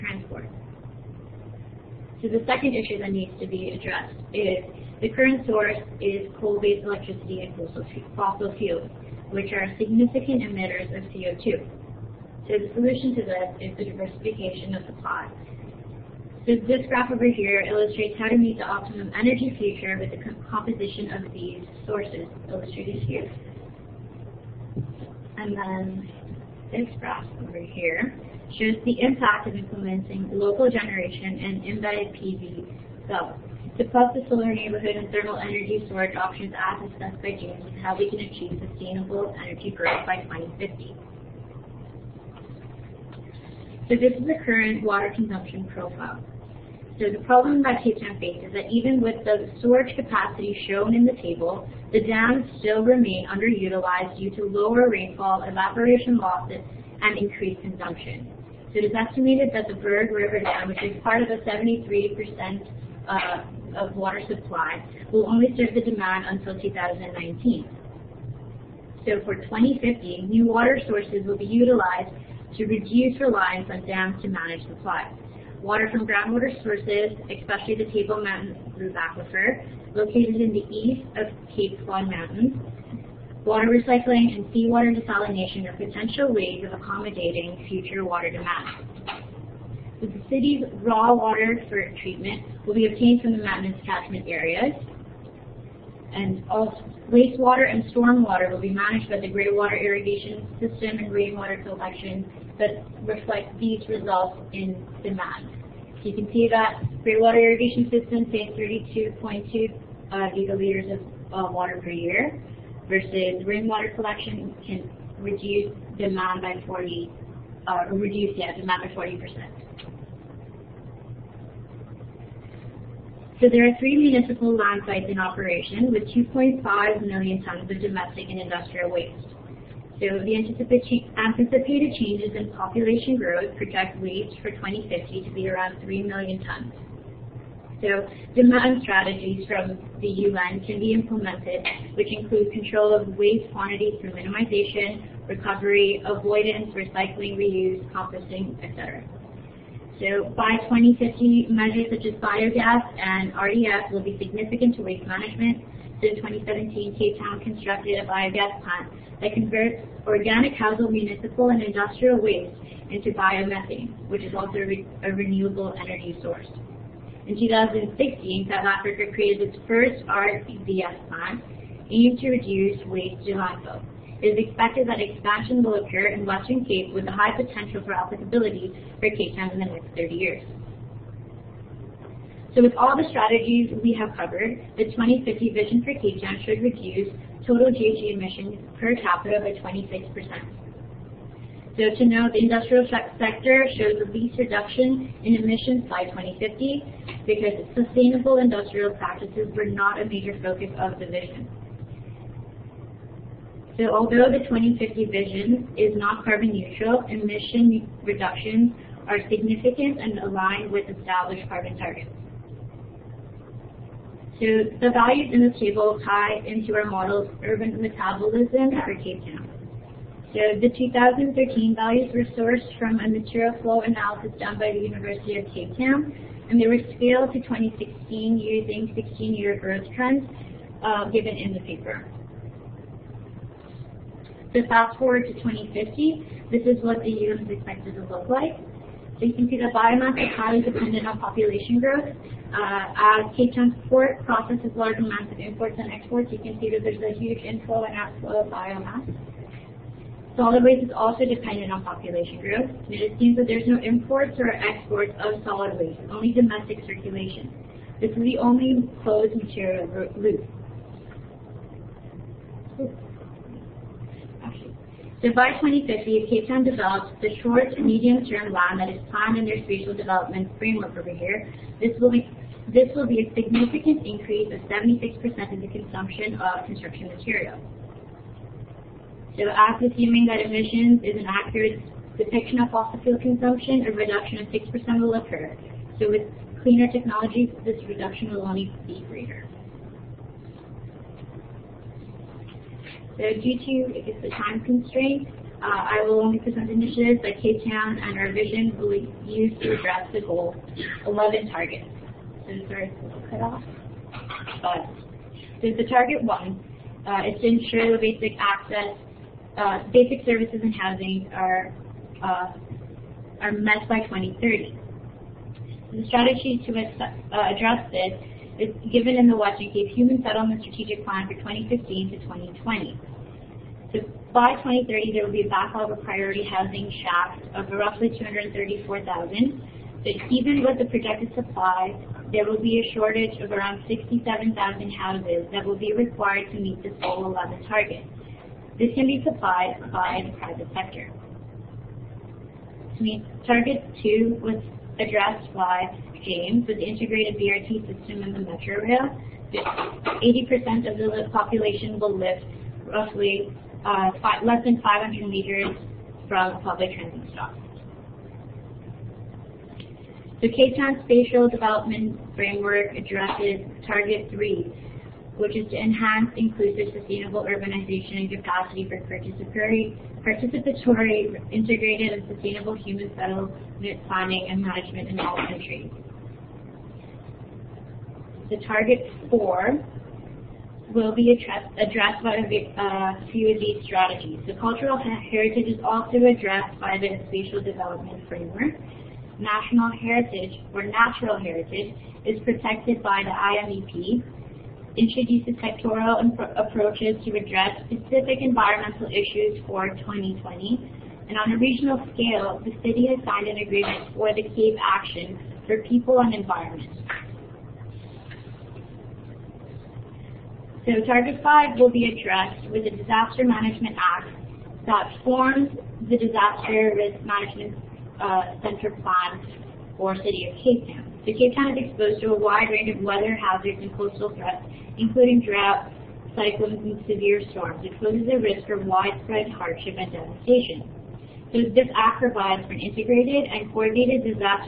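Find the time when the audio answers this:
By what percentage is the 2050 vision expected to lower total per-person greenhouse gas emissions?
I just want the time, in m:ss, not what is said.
3:09.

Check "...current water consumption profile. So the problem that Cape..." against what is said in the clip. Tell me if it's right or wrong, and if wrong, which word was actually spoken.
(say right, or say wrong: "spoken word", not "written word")
right.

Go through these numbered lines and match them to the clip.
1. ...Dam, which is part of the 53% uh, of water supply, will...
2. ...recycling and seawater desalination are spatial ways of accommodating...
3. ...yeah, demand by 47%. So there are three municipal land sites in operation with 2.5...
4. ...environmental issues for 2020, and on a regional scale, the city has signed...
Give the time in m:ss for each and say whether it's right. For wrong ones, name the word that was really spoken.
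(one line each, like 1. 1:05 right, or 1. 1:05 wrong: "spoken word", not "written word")
1. 1:00 wrong: "73", not "53"
2. 1:23 wrong: "potential", not "spatial"
3. 1:58 wrong: "40", not "47"
4. 6:38 right.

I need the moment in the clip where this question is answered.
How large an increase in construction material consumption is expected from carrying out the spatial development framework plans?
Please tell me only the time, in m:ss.
4:34.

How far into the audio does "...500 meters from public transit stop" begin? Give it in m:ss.
5:54.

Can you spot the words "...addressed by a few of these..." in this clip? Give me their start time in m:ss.
6:21.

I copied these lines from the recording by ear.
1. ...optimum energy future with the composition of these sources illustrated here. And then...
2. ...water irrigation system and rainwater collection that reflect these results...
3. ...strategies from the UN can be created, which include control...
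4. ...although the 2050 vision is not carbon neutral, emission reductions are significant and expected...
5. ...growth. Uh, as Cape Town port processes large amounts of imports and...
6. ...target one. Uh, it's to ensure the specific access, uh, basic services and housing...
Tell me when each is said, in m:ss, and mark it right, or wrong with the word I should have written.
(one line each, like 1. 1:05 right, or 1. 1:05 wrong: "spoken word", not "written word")
1. 0:18 right
2. 1:39 right
3. 2:18 wrong: "implemented", not "created"
4. 3:23 wrong: "aligned", not "expected"
5. 4:01 right
6. 5:05 wrong: "basic", not "specific".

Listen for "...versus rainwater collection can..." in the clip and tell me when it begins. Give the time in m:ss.
1:52.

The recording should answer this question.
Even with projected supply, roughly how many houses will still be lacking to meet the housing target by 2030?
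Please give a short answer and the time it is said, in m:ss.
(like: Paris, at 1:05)
67,000, at 5:33.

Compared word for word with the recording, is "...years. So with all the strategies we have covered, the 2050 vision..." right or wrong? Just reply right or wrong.
right.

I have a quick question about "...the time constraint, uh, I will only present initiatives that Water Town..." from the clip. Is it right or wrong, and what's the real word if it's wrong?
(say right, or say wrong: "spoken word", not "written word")
wrong: "Cape", not "Water".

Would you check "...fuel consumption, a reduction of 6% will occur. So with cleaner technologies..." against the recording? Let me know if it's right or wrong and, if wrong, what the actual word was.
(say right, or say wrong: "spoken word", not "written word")
right.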